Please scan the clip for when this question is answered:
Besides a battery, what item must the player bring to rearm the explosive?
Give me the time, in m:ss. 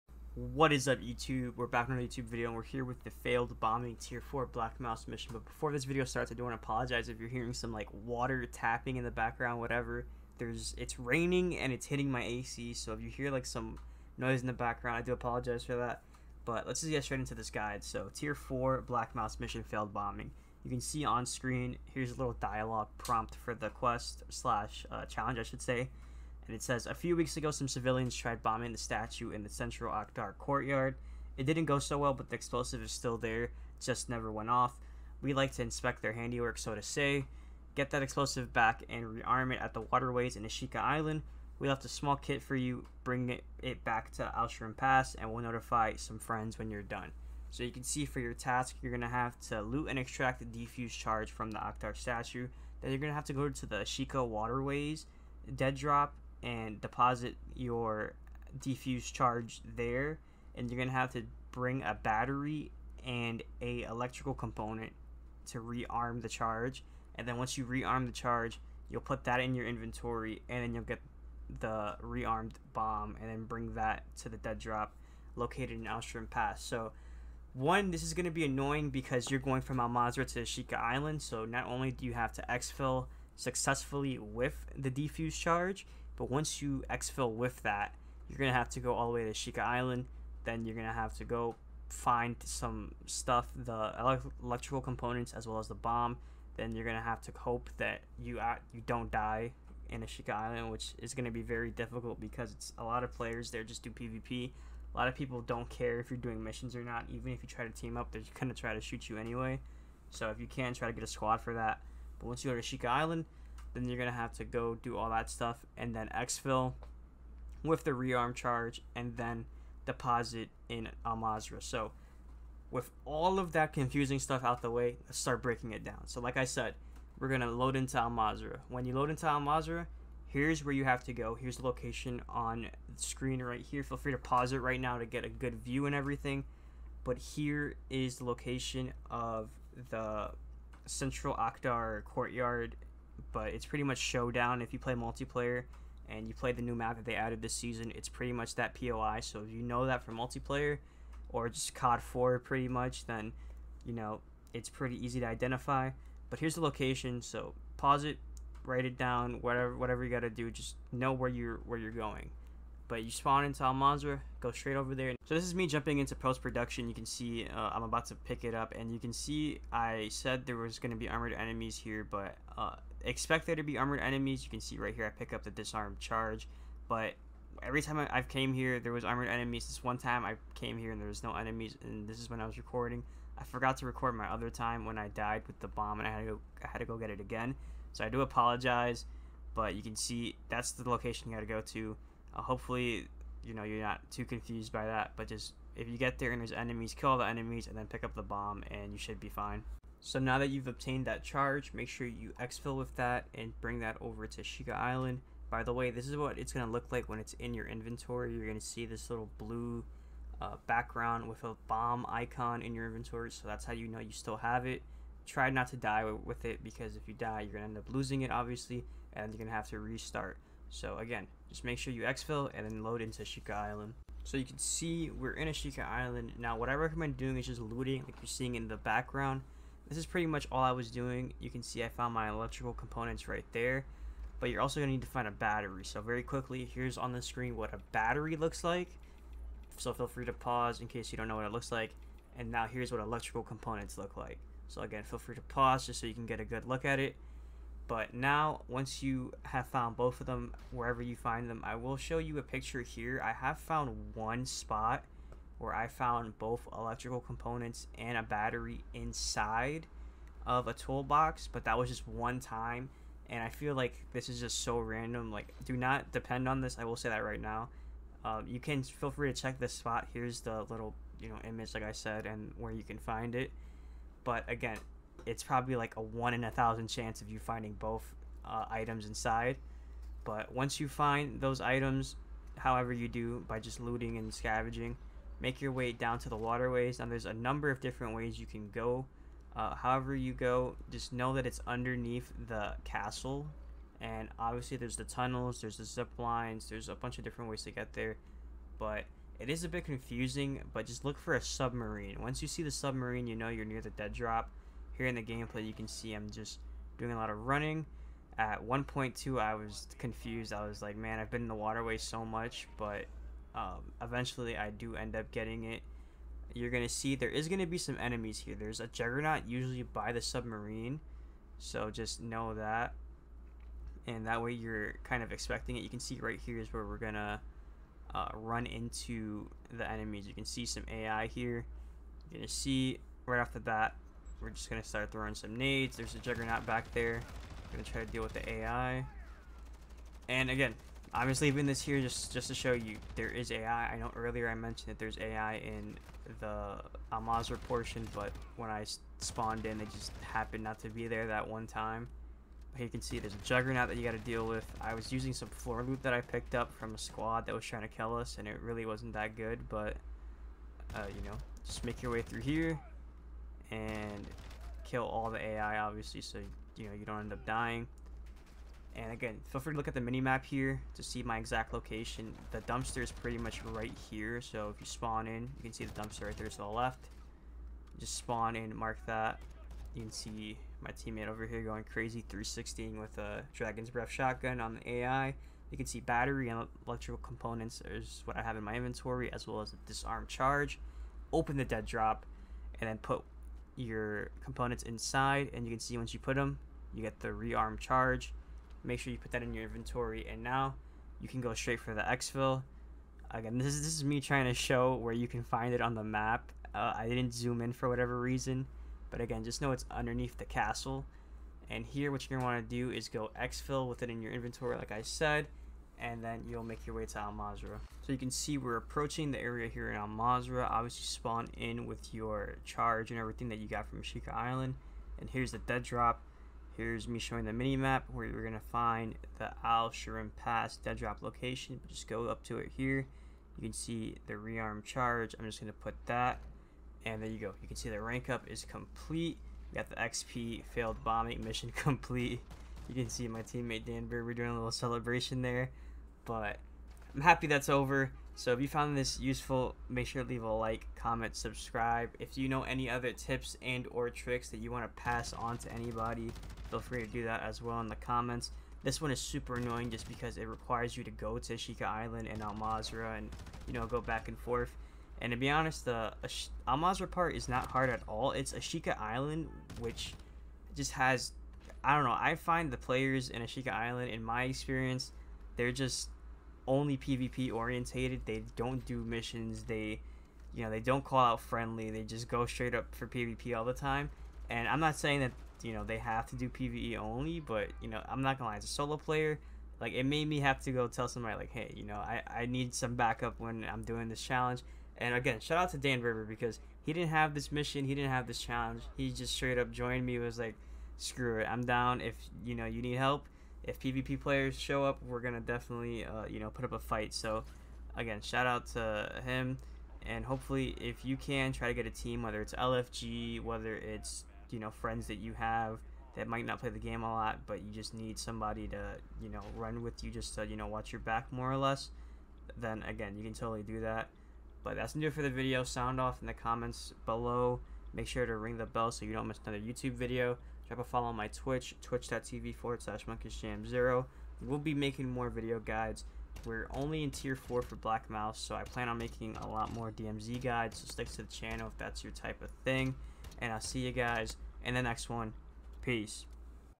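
1:03.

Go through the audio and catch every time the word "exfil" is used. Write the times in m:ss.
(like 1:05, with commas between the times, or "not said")
1:22, 1:26, 1:56, 3:22, 3:42, 6:42, 6:53.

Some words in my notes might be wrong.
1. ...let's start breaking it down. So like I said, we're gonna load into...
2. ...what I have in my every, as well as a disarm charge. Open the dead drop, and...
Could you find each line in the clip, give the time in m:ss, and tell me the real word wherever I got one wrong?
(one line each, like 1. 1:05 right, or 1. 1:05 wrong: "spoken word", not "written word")
1. 2:05 right
2. 6:28 wrong: "inventory", not "every".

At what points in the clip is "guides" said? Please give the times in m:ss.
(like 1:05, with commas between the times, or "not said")
0:17, 8:55, 9:00.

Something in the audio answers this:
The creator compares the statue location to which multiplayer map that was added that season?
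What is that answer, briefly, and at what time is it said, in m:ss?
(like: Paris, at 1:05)
Showdown, at 2:23.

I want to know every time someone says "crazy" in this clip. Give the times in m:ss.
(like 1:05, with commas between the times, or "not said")
6:21.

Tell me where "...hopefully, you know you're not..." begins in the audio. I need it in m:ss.
3:12.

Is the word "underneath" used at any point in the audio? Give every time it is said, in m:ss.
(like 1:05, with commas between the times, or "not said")
4:51, 6:49.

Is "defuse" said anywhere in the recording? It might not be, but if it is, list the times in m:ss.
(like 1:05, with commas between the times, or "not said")
0:50, 0:58, 1:24.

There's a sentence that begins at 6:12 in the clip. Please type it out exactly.
The dumpster is pretty much right here, so if you spawn in, you can see the dumpster right there to the left.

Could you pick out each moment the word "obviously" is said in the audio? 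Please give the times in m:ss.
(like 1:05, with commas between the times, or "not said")
3:38, 4:54, 6:05, 7:00.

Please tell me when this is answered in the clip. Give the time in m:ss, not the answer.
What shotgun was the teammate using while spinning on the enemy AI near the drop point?
6:23.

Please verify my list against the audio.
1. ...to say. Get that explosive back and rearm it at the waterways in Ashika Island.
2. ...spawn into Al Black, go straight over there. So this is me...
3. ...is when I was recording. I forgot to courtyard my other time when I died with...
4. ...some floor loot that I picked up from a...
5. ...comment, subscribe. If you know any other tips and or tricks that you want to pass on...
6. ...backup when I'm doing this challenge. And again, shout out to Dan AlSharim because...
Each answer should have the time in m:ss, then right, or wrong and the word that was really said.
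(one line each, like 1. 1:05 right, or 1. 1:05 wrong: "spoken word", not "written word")
1. 0:36 right
2. 2:43 wrong: "Mazrah", not "Black"
3. 3:02 wrong: "record", not "courtyard"
4. 5:55 right
5. 7:30 right
6. 8:12 wrong: "River", not "AlSharim".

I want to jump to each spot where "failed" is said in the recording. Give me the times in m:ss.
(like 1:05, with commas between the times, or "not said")
0:03, 0:19, 7:20.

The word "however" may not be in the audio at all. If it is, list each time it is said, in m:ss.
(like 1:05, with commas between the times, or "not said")
4:42, 4:49.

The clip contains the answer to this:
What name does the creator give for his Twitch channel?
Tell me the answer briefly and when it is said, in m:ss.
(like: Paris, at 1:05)
monkishjam0, at 8:53.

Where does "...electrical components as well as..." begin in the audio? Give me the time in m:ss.
1:34.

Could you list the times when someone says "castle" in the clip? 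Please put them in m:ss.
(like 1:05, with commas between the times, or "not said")
4:52, 6:50.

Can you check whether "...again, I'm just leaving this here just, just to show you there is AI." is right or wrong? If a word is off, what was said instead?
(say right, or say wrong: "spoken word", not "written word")
right.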